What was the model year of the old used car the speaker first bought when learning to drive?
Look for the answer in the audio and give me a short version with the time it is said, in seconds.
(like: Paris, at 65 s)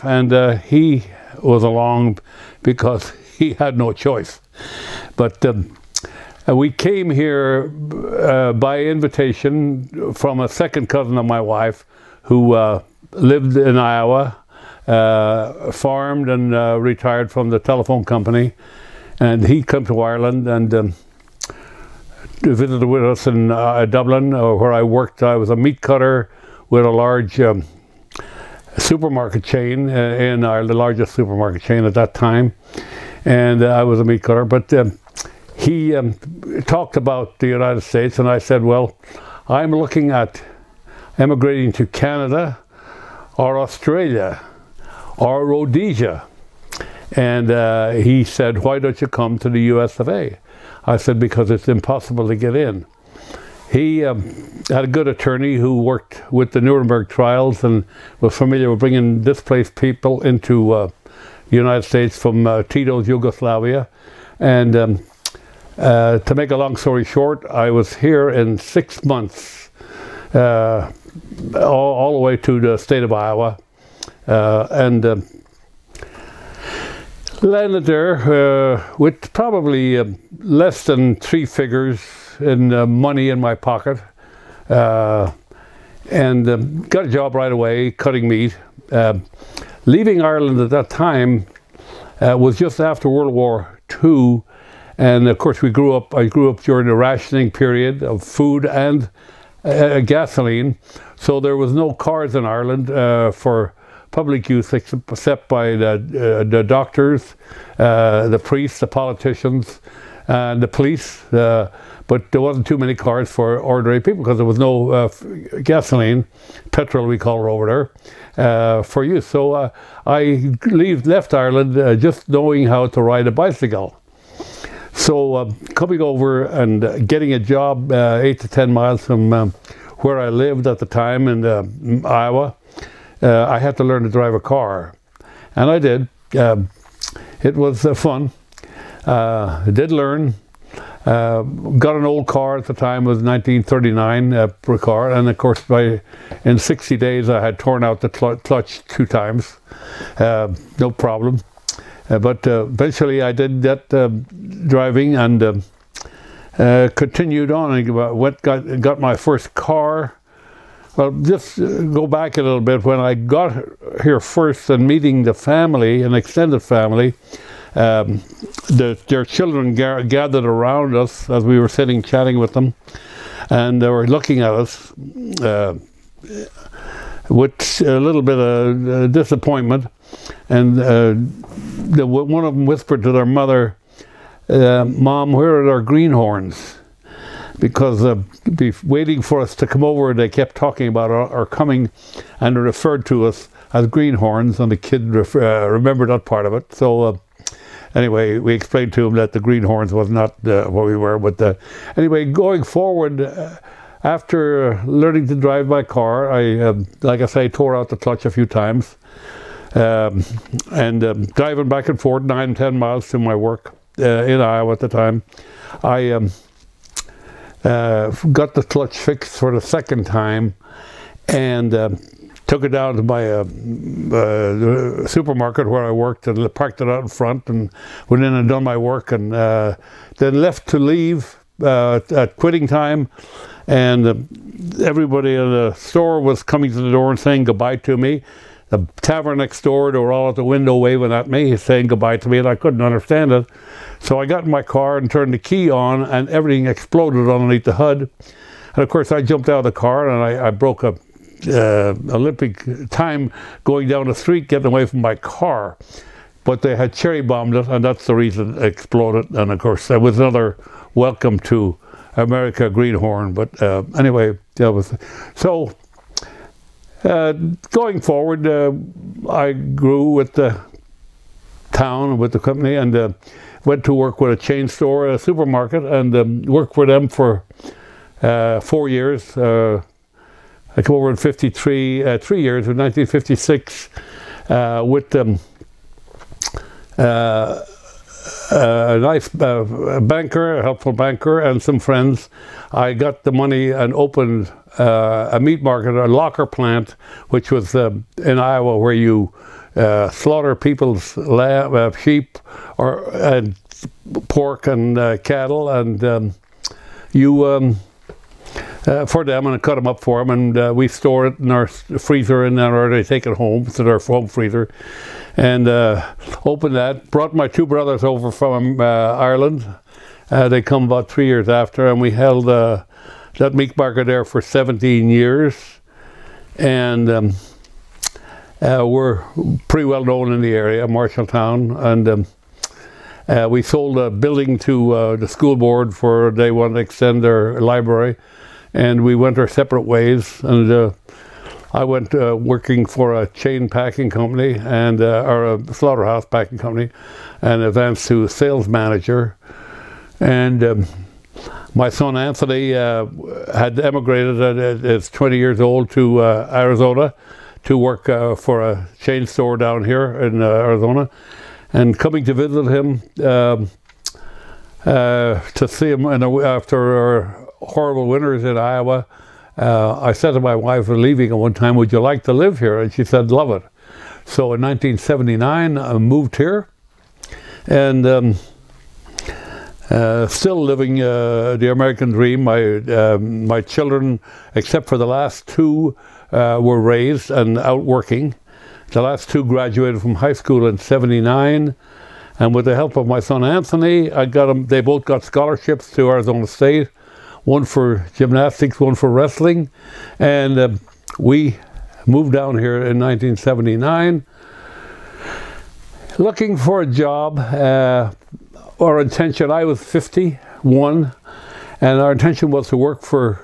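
1939, at 143 s.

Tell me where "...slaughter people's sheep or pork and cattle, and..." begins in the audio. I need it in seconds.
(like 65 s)
300 s.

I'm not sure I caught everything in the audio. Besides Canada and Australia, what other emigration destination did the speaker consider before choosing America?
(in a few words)
Rhodesia.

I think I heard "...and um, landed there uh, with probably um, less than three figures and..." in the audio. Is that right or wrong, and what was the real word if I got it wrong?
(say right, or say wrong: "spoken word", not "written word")
right.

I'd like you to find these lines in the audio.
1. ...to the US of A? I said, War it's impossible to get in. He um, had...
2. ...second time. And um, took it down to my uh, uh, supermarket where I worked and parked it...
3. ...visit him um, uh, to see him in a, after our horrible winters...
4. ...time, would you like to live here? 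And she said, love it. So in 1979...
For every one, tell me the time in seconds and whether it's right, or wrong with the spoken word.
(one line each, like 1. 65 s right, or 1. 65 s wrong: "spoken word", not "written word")
1. 49 s wrong: "Because", not "War"
2. 219 s right
3. 362 s right
4. 371 s right.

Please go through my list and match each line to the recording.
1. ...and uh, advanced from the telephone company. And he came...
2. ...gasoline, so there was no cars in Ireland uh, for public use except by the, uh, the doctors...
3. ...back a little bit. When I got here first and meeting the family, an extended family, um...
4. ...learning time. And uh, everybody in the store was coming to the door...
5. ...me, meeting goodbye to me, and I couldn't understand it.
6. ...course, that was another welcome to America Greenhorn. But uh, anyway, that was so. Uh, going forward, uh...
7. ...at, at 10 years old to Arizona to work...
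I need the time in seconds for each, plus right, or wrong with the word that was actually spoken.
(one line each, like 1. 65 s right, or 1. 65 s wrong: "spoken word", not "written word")
1. 16 s wrong: "retired", not "advanced"
2. 99 s right
3. 162 s right
4. 232 s wrong: "quitting", not "learning"
5. 241 s wrong: "saying", not "meeting"
6. 259 s right
7. 354 s wrong: "20", not "10".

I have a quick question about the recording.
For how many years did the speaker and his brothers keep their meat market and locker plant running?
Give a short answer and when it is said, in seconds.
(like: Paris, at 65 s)
17, at 324 s.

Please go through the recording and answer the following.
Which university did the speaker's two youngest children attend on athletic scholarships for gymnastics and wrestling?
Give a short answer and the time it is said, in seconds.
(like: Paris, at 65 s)
Arizona State, at 396 s.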